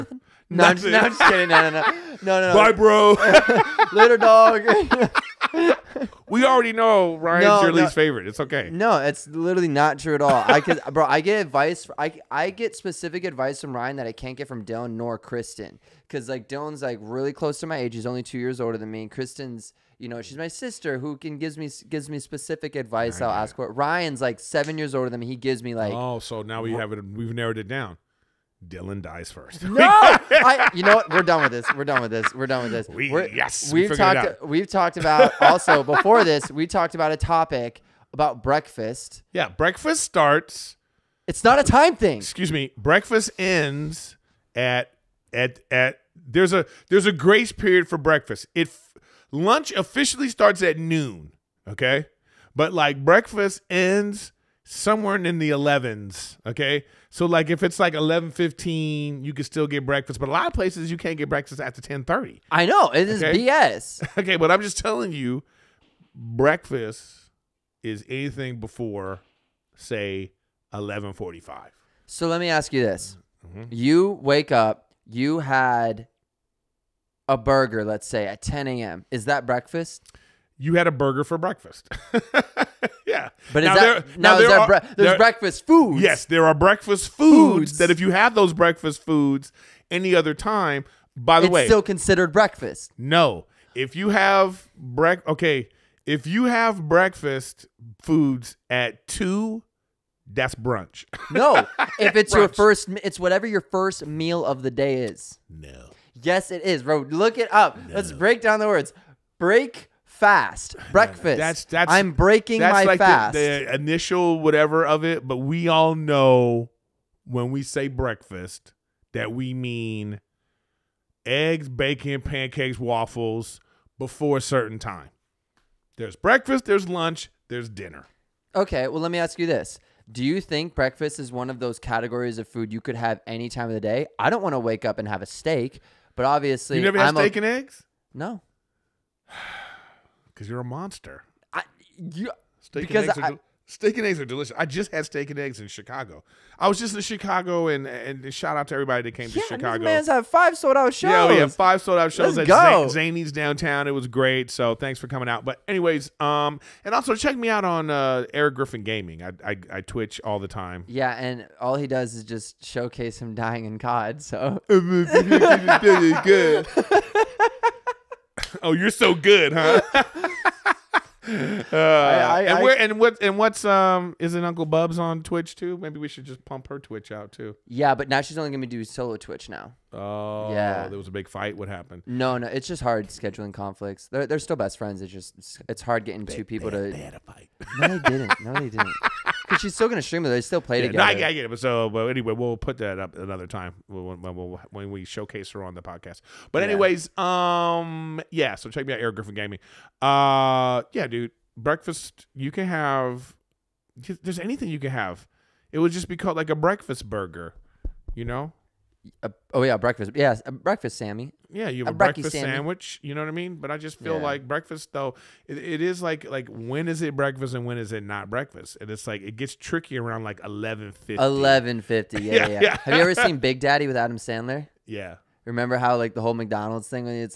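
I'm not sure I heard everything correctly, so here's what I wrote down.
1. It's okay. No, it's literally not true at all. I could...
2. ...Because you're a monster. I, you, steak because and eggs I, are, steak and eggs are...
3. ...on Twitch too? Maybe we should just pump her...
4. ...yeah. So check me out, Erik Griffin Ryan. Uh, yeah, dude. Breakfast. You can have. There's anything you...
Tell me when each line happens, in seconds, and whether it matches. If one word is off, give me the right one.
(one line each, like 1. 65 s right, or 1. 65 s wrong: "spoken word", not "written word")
1. 8 s right
2. 140 s right
3. 174 s right
4. 198 s wrong: "Gaming", not "Ryan".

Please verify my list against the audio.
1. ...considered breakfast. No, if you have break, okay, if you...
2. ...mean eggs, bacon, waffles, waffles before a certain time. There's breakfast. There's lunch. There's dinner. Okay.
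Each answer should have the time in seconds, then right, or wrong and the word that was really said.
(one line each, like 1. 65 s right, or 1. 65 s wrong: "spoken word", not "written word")
1. 91 s right
2. 119 s wrong: "pancakes", not "waffles".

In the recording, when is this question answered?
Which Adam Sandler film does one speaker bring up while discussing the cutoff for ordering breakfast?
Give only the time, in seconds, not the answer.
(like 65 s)
223 s.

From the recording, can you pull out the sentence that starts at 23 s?
Right, I'll ask what Ryan's like seven years older than me.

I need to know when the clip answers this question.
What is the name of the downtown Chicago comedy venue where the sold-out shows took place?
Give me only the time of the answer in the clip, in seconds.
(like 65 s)
152 s.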